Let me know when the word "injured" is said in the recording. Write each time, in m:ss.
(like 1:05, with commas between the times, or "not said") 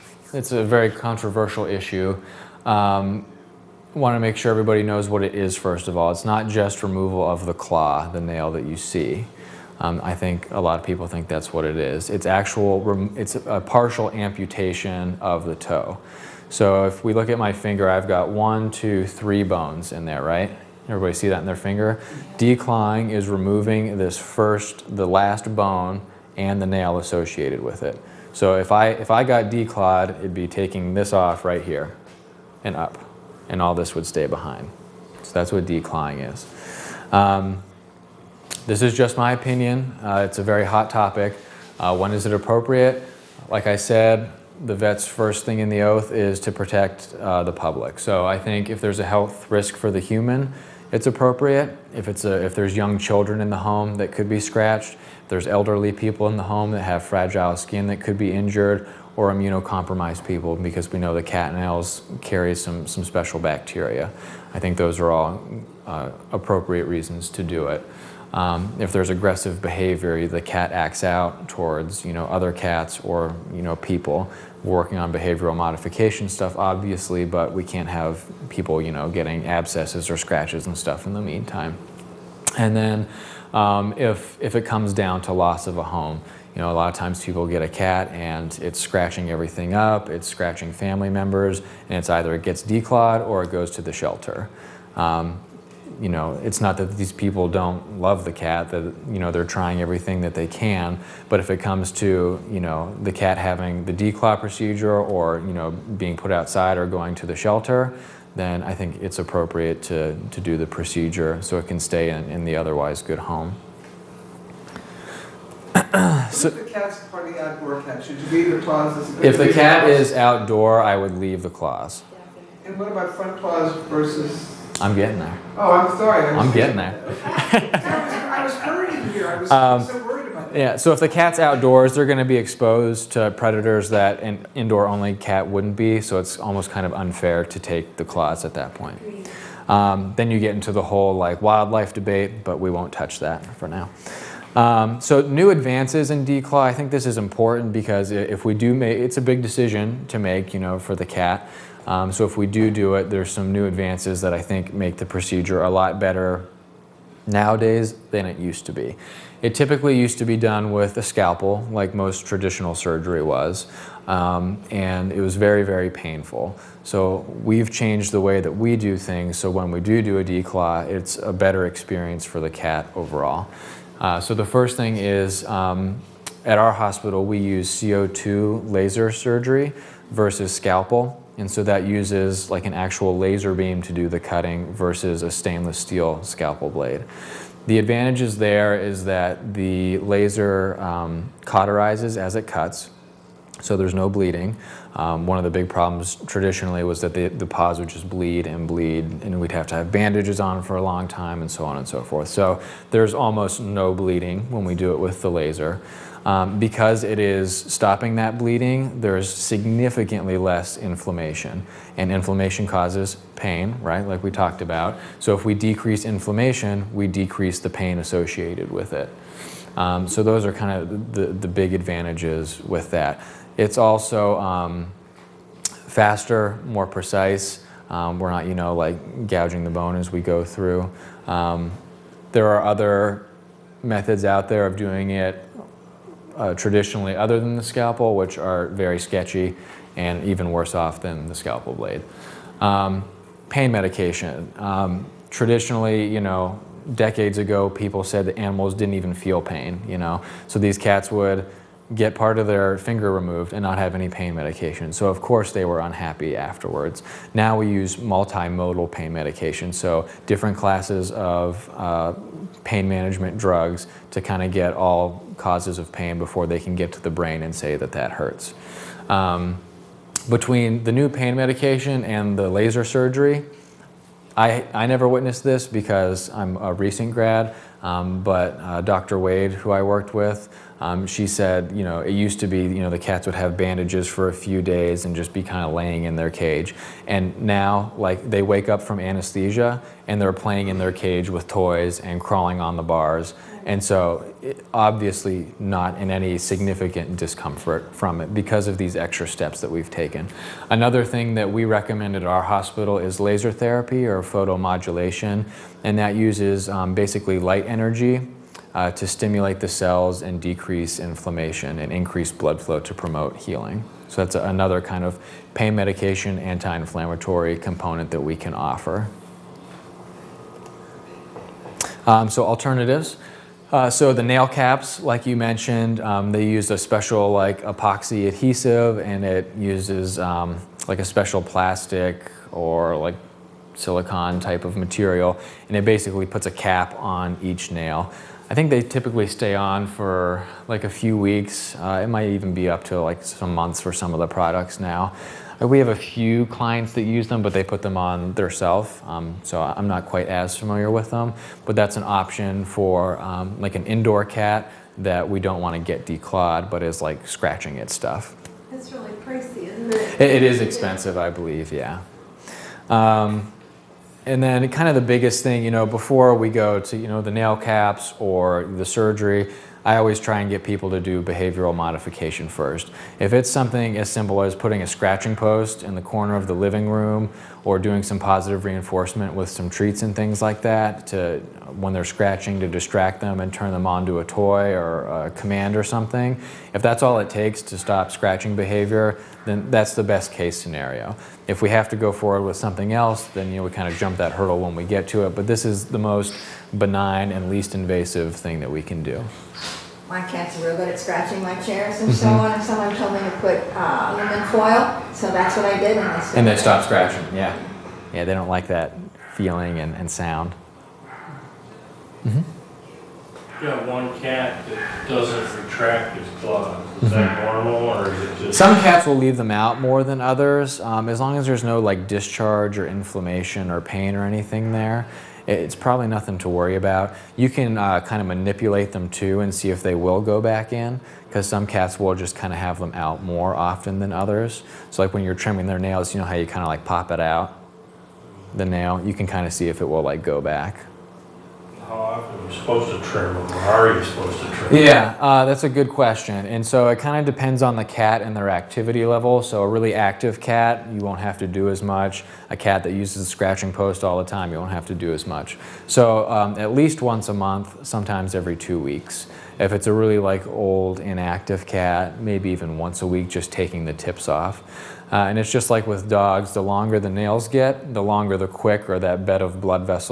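0:58.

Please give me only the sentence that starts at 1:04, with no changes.
I think those are all uh, appropriate reasons to do it.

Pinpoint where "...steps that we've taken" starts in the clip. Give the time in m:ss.
4:59.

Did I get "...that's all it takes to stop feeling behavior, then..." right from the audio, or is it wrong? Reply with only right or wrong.
wrong.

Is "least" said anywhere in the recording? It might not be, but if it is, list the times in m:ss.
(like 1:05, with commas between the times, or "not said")
6:37, 7:36.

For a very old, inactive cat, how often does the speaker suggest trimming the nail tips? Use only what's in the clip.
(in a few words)
Once a week.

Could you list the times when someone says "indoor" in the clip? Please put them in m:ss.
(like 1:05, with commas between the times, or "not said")
2:14, 5:53.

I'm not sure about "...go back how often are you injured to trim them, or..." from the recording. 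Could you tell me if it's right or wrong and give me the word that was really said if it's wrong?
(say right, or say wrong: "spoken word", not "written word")
wrong: "supposed", not "injured".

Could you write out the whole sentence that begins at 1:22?
And then um, if, if it comes down to loss of a home.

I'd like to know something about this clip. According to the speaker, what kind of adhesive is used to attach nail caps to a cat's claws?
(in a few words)
Epoxy.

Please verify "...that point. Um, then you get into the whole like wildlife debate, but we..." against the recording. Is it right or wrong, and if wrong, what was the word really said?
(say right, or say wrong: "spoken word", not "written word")
right.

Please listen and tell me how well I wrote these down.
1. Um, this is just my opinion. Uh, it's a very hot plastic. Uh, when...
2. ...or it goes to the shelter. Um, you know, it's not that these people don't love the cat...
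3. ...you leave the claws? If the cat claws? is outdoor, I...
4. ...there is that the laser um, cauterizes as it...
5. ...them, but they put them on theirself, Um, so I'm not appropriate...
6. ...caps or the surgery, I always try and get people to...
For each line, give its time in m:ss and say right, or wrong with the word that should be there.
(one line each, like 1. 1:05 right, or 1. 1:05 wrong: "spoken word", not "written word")
1. 0:37 wrong: "topic", not "plastic"
2. 1:33 right
3. 1:58 right
4. 3:08 right
5. 5:47 wrong: "quite", not "appropriate"
6. 6:07 right.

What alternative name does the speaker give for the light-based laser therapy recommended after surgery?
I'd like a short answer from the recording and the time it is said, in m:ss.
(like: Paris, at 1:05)
Photomodulation, at 5:04.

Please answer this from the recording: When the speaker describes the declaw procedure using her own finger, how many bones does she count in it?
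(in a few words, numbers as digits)
3.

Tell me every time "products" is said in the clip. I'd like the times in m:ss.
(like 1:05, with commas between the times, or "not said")
5:44.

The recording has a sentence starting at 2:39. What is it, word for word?
It typically used to be done with a scalpel, like most traditional surgery was, um, and it was very, very painful.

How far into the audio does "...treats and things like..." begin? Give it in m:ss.
6:19.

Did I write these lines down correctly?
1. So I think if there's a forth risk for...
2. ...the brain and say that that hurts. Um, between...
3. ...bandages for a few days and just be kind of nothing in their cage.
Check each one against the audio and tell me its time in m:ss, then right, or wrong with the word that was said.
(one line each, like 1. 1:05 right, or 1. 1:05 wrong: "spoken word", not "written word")
1. 0:47 wrong: "health", not "forth"
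2. 4:27 right
3. 4:43 wrong: "laying", not "nothing".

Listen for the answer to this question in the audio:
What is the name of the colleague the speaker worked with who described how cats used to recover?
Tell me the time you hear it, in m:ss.
4:38.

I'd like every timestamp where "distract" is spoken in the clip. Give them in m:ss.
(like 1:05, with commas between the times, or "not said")
6:22.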